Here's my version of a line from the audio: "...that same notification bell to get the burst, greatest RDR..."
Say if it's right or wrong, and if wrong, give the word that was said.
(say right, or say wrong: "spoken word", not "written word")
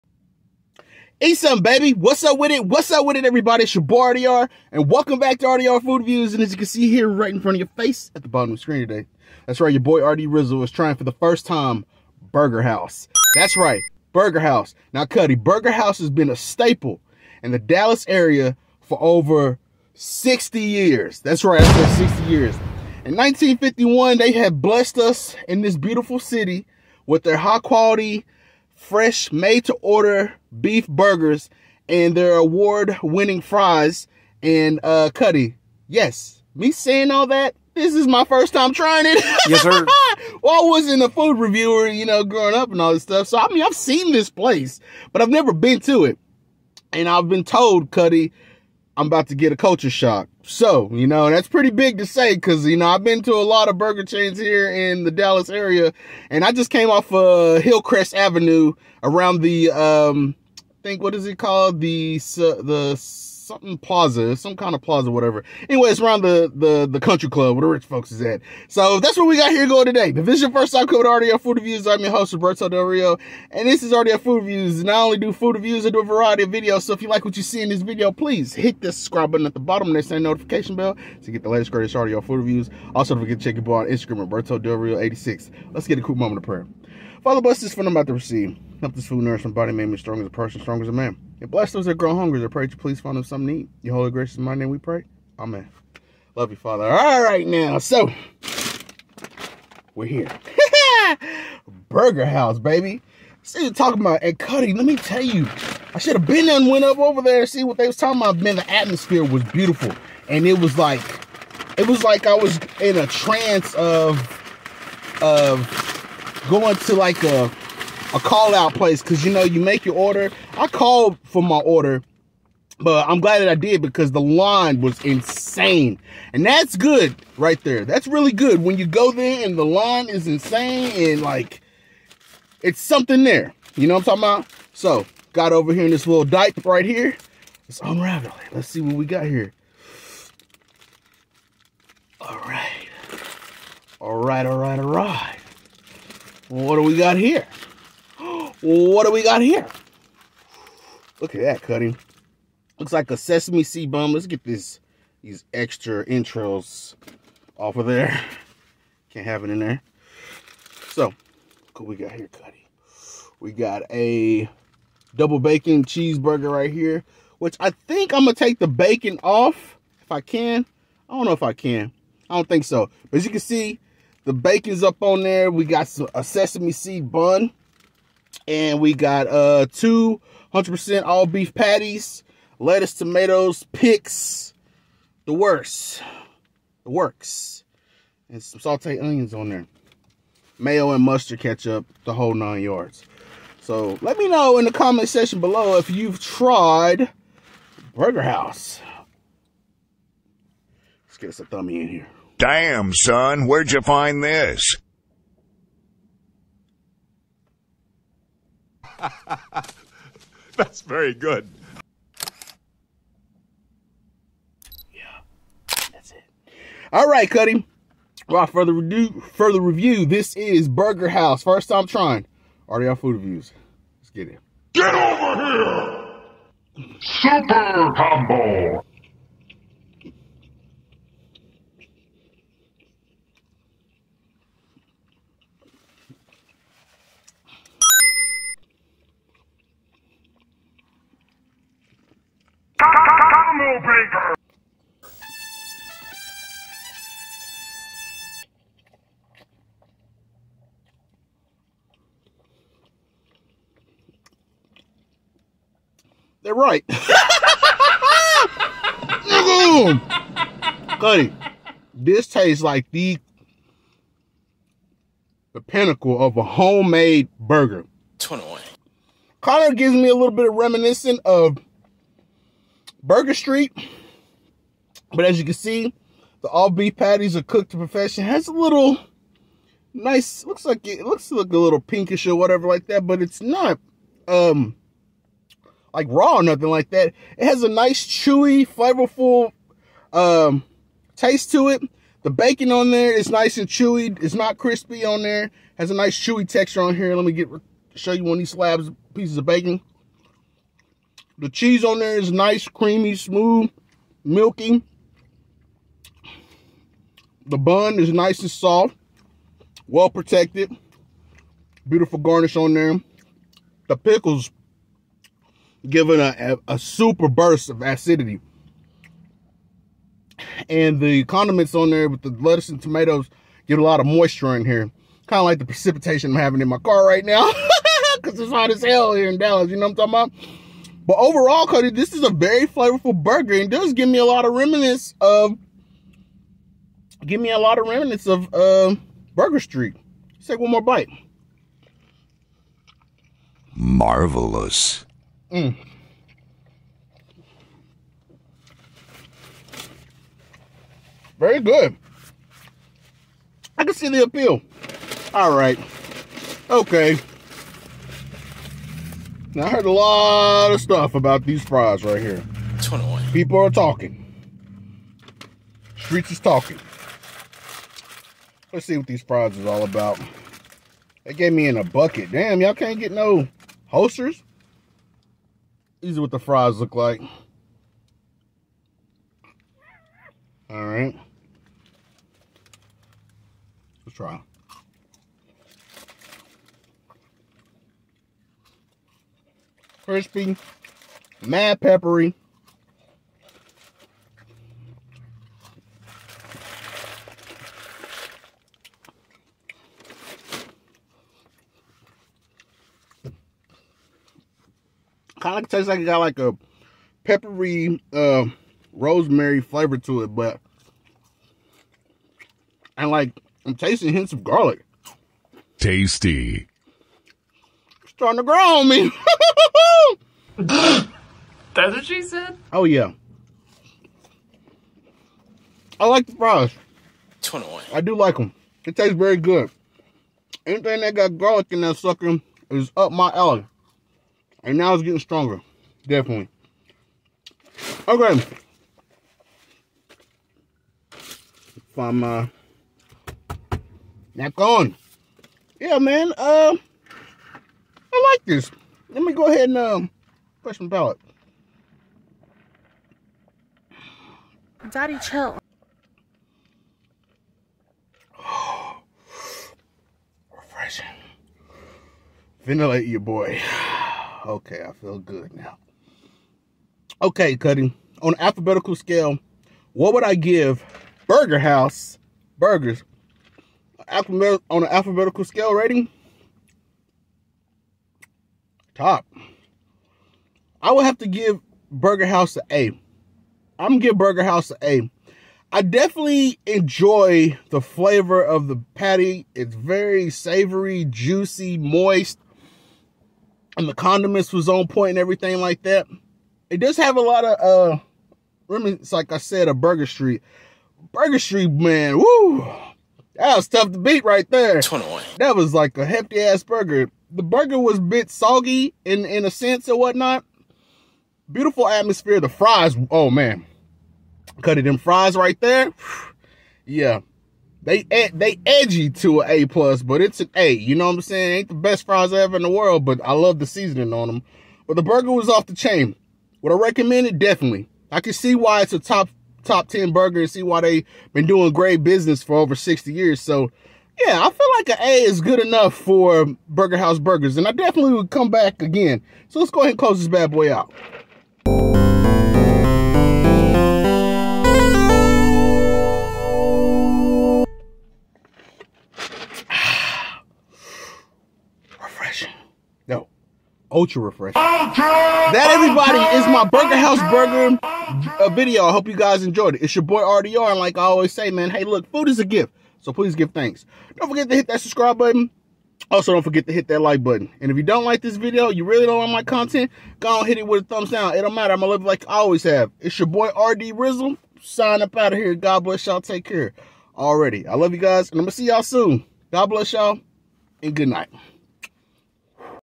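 wrong: "latest", not "burst".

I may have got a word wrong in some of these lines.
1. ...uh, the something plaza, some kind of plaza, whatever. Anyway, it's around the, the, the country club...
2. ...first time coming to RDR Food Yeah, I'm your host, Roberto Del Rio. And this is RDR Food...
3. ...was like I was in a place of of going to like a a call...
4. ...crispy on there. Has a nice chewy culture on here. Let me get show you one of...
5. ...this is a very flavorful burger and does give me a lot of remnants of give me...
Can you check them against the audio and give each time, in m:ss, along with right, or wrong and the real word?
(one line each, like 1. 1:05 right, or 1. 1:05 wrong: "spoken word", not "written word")
1. 1:02 right
2. 1:10 wrong: "Reviews", not "Yeah"
3. 1:51 wrong: "trance", not "place"
4. 4:54 wrong: "texture", not "culture"
5. 5:31 right.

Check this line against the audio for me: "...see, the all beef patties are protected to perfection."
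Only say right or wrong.
wrong.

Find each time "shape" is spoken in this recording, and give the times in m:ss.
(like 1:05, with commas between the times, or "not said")
not said.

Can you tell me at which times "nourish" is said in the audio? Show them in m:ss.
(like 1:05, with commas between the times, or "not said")
1:29.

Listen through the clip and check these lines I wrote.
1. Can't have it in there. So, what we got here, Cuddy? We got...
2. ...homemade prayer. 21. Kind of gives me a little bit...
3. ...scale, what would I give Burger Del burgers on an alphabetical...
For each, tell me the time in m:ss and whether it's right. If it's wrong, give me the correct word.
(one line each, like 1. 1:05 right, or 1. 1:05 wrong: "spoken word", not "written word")
1. 2:39 right
2. 4:26 wrong: "burger", not "prayer"
3. 7:48 wrong: "House", not "Del".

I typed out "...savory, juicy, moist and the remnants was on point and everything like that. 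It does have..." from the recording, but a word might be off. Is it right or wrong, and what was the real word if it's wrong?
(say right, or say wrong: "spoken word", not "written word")
wrong: "condiments", not "remnants".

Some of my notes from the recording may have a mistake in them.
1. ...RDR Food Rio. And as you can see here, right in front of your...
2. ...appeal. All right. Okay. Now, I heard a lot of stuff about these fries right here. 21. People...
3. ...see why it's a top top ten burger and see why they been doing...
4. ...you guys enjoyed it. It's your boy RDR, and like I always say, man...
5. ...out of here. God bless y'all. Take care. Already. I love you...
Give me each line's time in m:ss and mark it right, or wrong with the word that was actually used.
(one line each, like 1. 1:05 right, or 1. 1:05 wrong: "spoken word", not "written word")
1. 0:05 wrong: "Views", not "Rio"
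2. 5:54 right
3. 8:48 right
4. 9:19 right
5. 9:35 right.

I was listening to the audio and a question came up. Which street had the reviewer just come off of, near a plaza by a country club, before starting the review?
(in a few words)
Hillcrest Avenue.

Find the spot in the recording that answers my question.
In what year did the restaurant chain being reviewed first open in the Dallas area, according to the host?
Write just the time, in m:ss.
0:23.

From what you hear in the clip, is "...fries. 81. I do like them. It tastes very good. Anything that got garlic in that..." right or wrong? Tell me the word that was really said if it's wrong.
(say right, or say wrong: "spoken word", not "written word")
wrong: "21", not "81".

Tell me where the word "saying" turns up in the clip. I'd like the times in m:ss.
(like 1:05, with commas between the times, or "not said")
0:36, 8:41.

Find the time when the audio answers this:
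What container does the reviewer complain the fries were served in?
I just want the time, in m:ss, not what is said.
6:11.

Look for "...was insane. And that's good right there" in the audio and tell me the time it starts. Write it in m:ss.
2:04.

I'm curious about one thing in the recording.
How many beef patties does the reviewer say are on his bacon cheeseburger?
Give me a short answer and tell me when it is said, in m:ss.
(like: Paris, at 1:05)
2, at 2:59.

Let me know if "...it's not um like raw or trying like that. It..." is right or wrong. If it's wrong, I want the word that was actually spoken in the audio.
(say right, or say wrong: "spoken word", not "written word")
wrong: "nothing", not "trying".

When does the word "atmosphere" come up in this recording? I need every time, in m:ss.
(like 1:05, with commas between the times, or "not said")
1:48, 8:31.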